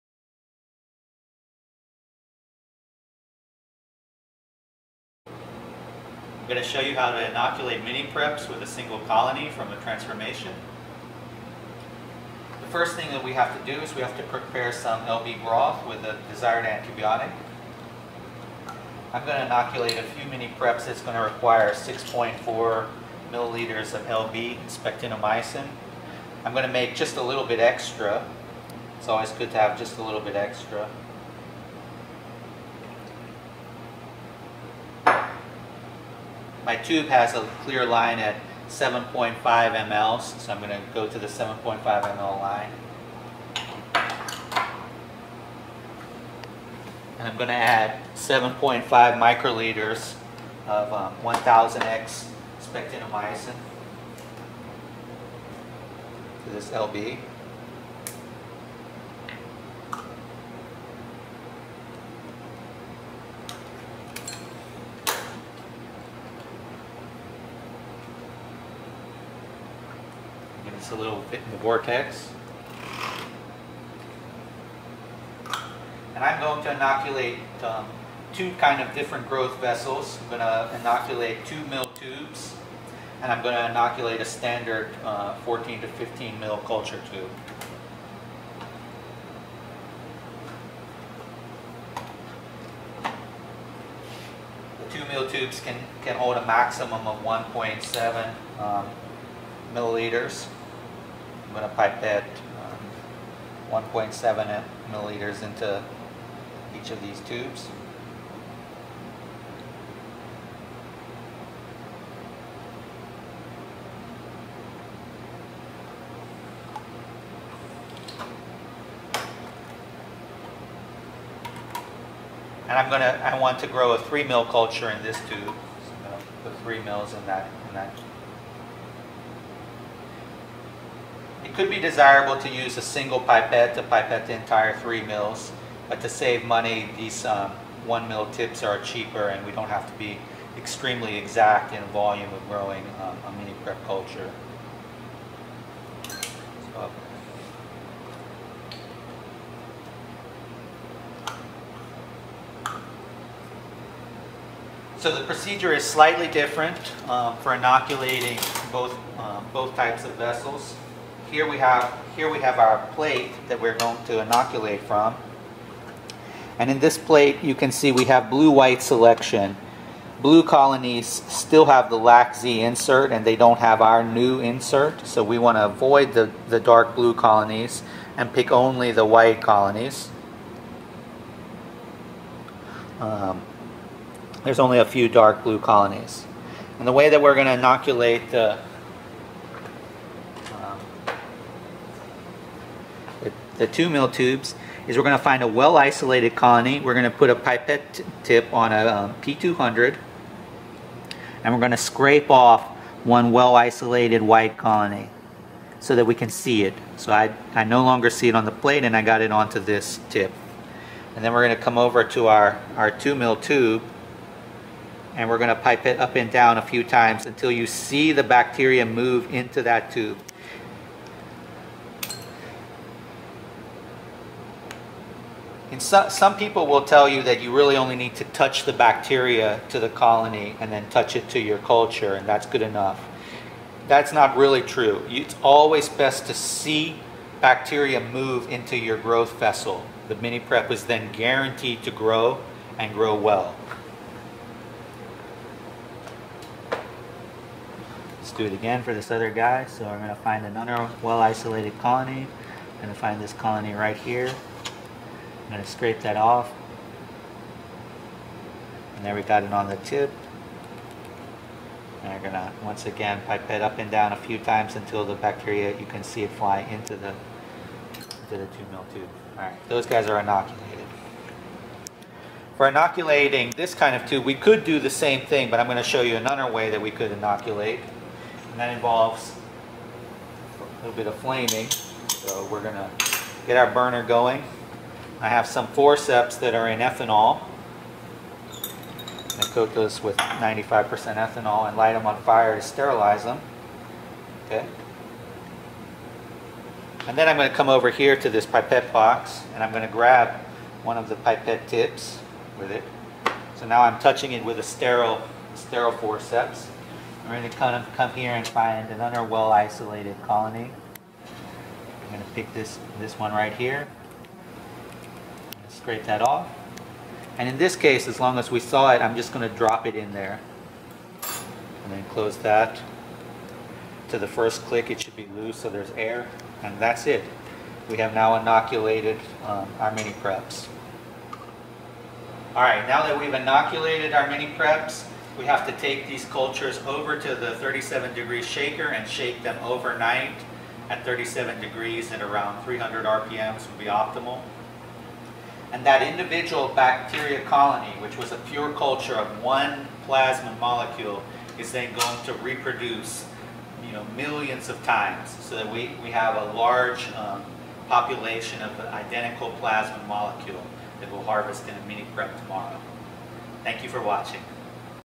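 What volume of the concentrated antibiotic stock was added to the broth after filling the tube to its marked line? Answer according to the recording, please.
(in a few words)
7.5 µl.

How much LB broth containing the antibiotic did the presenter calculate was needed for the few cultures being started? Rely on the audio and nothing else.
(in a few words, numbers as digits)
6.4 ml.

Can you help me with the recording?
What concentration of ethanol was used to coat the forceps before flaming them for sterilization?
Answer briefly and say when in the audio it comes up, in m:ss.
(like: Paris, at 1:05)
95%, at 4:50.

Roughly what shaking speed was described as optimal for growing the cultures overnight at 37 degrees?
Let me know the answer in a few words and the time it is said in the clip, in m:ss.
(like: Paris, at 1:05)
300 RPM, at 5:42.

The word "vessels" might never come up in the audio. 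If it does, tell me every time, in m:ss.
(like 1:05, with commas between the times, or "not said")
1:19, 2:40, 3:59.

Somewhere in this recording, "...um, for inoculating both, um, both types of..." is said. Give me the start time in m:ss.
2:37.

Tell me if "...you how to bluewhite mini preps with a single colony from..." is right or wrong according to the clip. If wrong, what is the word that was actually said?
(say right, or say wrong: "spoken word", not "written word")
wrong: "inoculate", not "bluewhite".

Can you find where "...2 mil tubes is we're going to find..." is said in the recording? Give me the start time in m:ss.
3:13.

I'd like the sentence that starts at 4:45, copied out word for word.
I have some forceps that are in ethanol.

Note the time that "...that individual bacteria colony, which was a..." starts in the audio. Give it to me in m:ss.
5:45.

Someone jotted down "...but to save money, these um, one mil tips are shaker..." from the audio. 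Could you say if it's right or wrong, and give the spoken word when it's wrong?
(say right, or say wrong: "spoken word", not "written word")
wrong: "cheaper", not "shaker".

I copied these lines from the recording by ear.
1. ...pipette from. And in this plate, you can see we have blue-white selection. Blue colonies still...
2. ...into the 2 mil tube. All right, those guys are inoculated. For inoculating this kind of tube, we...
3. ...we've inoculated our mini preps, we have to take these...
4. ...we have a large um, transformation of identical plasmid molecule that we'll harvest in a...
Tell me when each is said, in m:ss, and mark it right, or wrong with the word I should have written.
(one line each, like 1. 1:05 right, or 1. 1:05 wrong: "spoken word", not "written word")
1. 2:44 wrong: "inoculate", not "pipette"
2. 4:27 right
3. 5:33 right
4. 5:56 wrong: "population", not "transformation".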